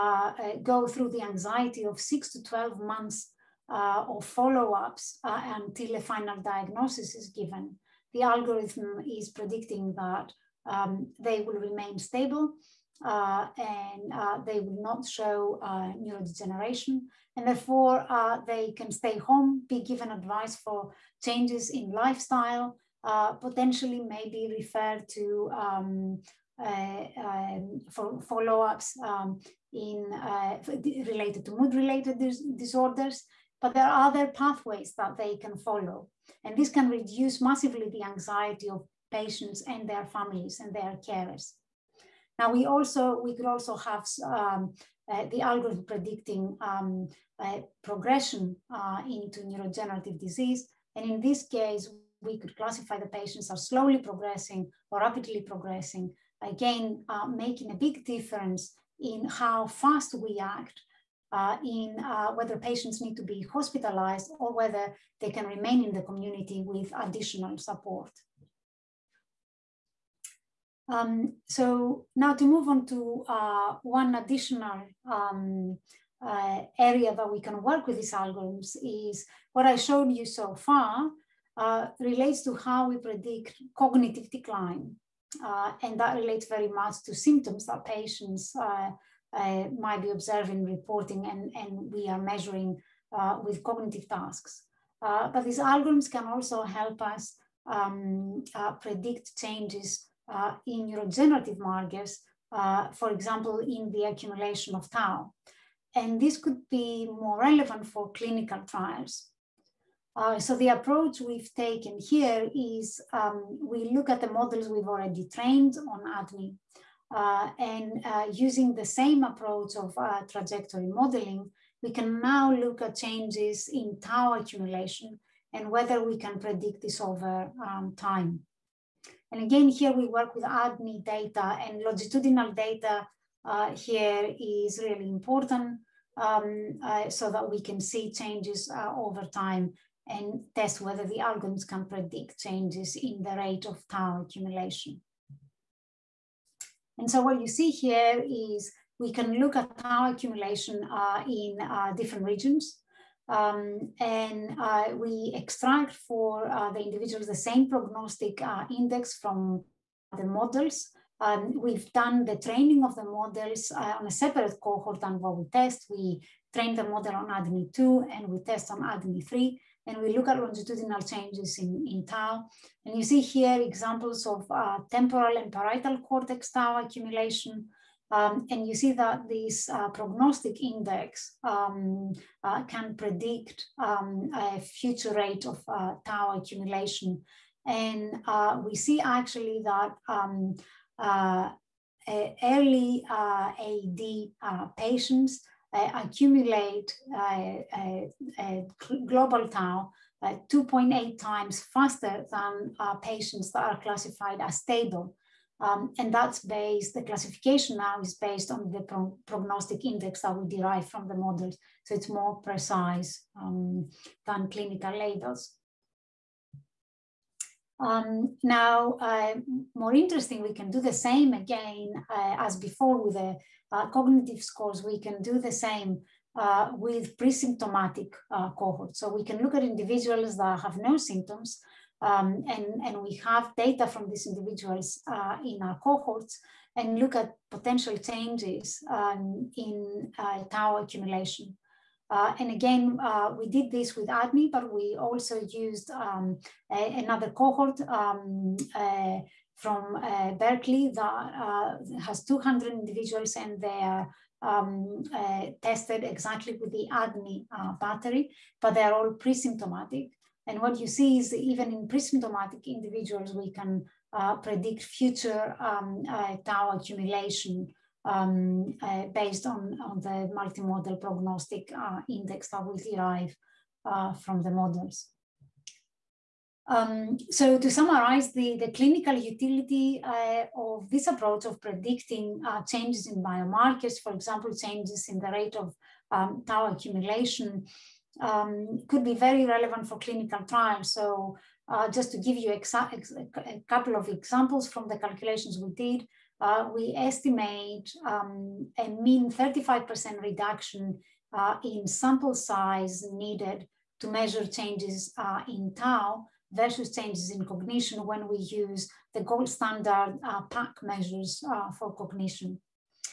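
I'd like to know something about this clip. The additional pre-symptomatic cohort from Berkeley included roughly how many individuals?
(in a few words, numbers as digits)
200.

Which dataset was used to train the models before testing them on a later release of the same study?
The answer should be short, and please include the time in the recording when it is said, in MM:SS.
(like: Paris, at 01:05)
ADNI2, at 02:47.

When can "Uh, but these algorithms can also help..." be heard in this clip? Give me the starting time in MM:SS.
01:35.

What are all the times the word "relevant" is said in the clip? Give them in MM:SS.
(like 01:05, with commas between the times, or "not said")
01:47, 04:49.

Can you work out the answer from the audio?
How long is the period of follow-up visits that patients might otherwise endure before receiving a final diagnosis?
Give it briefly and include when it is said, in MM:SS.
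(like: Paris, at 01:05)
6 to 12 months, at 00:01.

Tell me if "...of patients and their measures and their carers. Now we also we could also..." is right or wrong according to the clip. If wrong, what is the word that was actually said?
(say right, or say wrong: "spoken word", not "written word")
wrong: "families", not "measures".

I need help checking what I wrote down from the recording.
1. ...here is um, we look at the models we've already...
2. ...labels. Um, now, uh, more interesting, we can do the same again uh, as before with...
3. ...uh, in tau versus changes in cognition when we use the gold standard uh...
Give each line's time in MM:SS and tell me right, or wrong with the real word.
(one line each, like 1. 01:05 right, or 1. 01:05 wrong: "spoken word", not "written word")
1. 01:51 right
2. 03:34 right
3. 05:05 right.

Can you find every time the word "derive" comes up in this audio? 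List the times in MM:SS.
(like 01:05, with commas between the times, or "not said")
03:30, 04:32.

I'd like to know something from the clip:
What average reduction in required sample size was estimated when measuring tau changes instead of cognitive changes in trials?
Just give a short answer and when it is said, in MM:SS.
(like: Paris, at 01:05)
35%, at 04:59.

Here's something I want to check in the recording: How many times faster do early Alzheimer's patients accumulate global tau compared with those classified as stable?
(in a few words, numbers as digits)
2.8 times.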